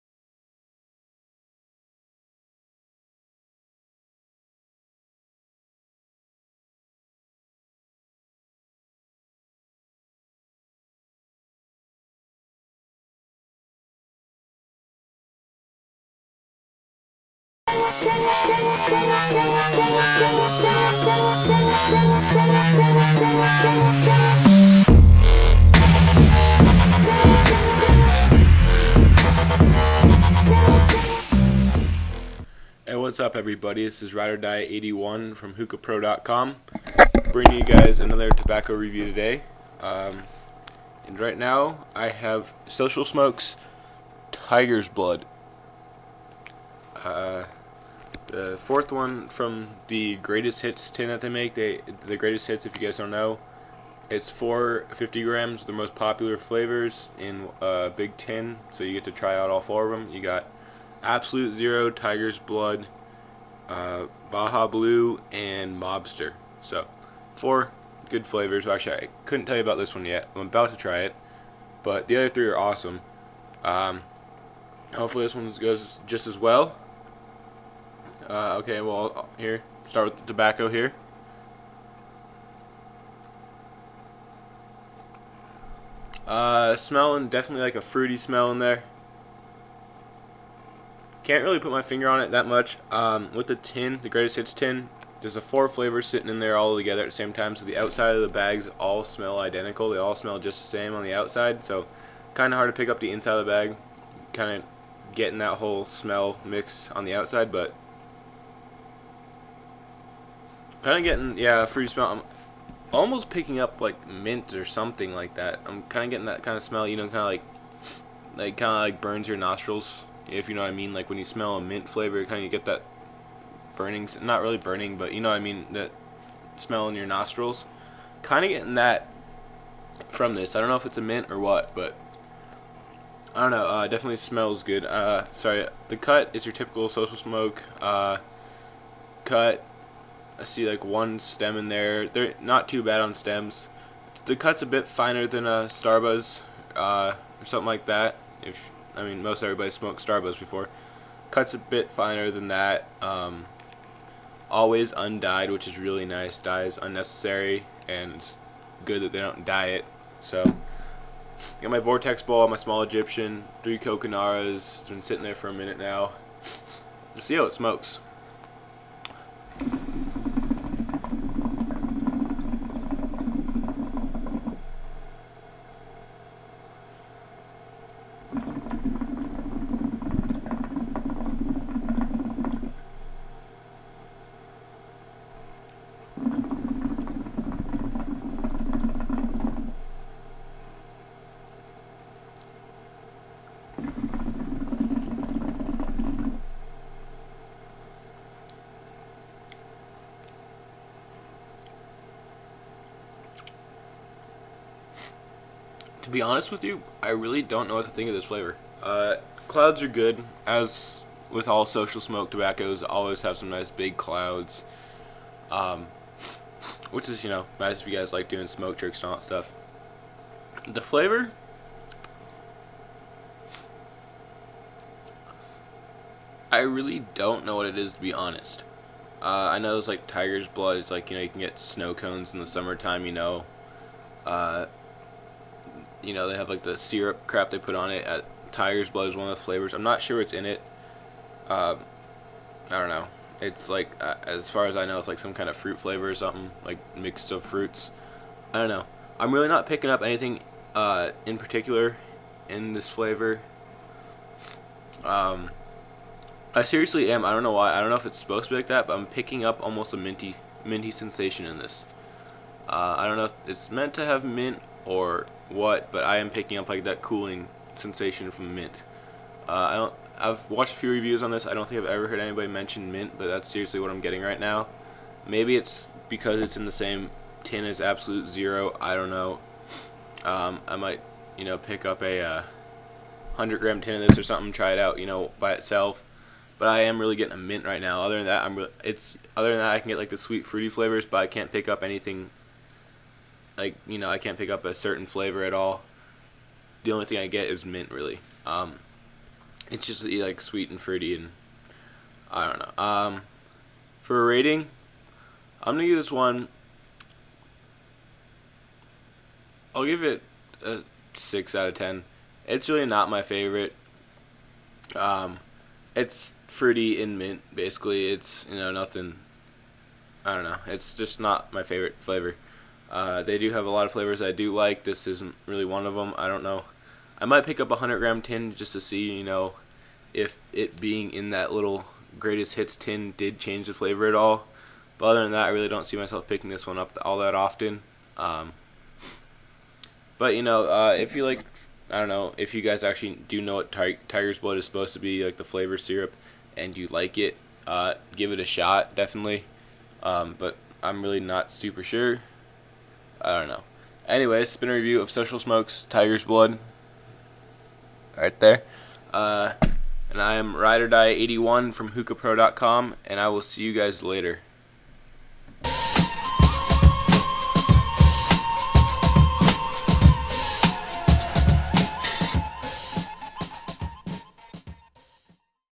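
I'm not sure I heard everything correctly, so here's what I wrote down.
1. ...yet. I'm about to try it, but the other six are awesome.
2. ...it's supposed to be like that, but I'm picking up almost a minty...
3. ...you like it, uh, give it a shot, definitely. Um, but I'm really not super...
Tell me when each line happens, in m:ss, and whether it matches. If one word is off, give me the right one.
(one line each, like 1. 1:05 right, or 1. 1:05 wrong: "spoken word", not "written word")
1. 1:10 wrong: "three", not "six"
2. 4:18 right
3. 5:46 right.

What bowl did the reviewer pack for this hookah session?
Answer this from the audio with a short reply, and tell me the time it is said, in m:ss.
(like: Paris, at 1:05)
Vortex, at 2:41.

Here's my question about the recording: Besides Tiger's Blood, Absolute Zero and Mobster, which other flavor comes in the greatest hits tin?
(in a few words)
Baja Blue.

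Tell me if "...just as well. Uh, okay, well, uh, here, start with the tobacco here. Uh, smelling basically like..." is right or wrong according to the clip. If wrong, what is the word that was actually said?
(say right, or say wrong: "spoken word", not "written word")
wrong: "definitely", not "basically".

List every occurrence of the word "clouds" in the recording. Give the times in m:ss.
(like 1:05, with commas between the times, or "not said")
3:29, 3:33.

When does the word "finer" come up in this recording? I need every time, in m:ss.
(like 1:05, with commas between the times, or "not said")
2:24, 2:31.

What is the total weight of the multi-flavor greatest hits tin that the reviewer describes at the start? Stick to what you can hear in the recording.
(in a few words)
450 grams.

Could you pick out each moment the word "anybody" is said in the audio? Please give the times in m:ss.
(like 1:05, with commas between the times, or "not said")
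4:32.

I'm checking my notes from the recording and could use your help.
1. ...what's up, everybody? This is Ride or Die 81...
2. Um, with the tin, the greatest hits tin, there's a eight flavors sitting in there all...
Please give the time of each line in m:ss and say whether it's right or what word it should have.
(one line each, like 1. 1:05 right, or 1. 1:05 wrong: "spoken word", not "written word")
1. 0:32 right
2. 1:32 wrong: "four", not "eight".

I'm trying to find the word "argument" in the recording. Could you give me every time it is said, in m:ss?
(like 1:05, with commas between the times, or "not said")
not said.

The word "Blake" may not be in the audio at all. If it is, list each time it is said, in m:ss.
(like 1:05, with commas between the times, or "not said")
not said.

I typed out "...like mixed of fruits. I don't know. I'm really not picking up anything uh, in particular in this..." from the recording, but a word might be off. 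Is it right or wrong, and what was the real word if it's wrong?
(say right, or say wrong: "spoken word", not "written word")
right.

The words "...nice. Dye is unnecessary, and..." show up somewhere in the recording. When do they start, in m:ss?
2:36.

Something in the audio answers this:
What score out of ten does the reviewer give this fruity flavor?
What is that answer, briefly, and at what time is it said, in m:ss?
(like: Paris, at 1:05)
6, at 5:11.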